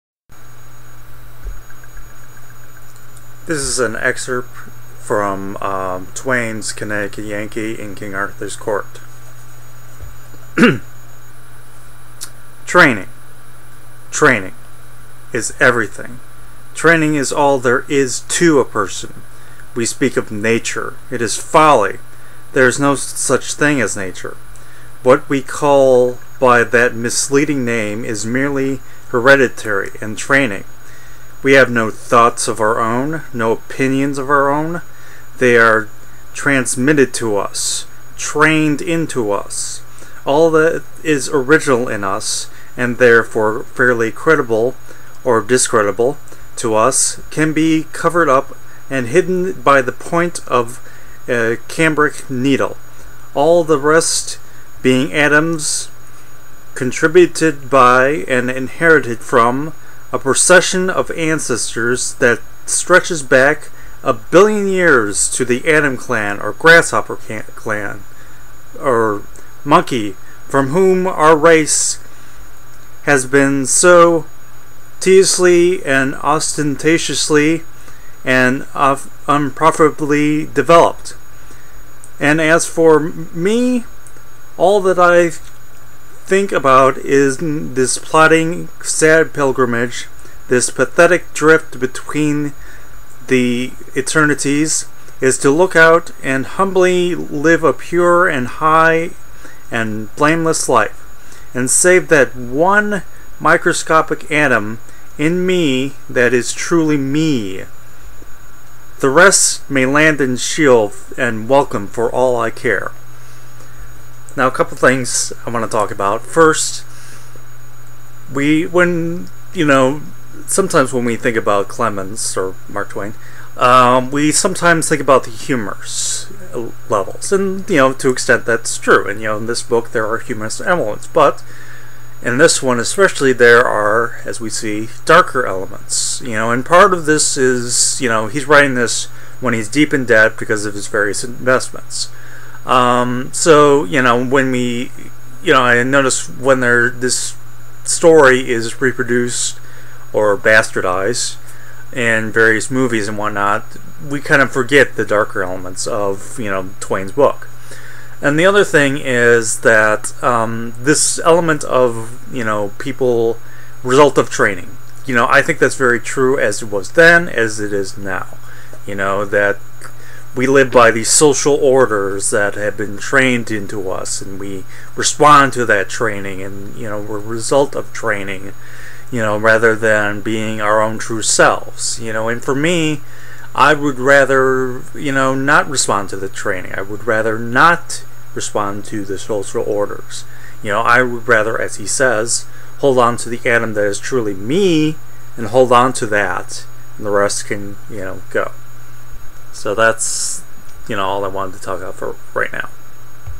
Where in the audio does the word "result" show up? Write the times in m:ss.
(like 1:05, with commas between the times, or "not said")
2:43, 2:57.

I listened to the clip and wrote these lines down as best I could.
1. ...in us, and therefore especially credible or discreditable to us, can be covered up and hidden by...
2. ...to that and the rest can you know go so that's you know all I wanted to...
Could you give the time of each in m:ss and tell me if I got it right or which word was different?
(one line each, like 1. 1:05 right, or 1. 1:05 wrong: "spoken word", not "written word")
1. 0:41 wrong: "fairly", not "especially"
2. 3:15 right.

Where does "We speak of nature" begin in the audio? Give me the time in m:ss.
0:19.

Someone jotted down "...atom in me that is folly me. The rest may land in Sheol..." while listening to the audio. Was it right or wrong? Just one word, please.
wrong.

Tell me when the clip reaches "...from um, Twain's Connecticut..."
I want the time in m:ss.
0:05.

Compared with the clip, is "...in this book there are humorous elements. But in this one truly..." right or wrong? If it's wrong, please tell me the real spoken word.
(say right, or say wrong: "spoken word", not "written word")
wrong: "especially", not "truly".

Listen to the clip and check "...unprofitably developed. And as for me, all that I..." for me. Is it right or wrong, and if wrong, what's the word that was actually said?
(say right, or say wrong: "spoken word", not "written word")
right.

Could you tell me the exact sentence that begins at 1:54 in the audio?
Now, a couple things I want to talk about.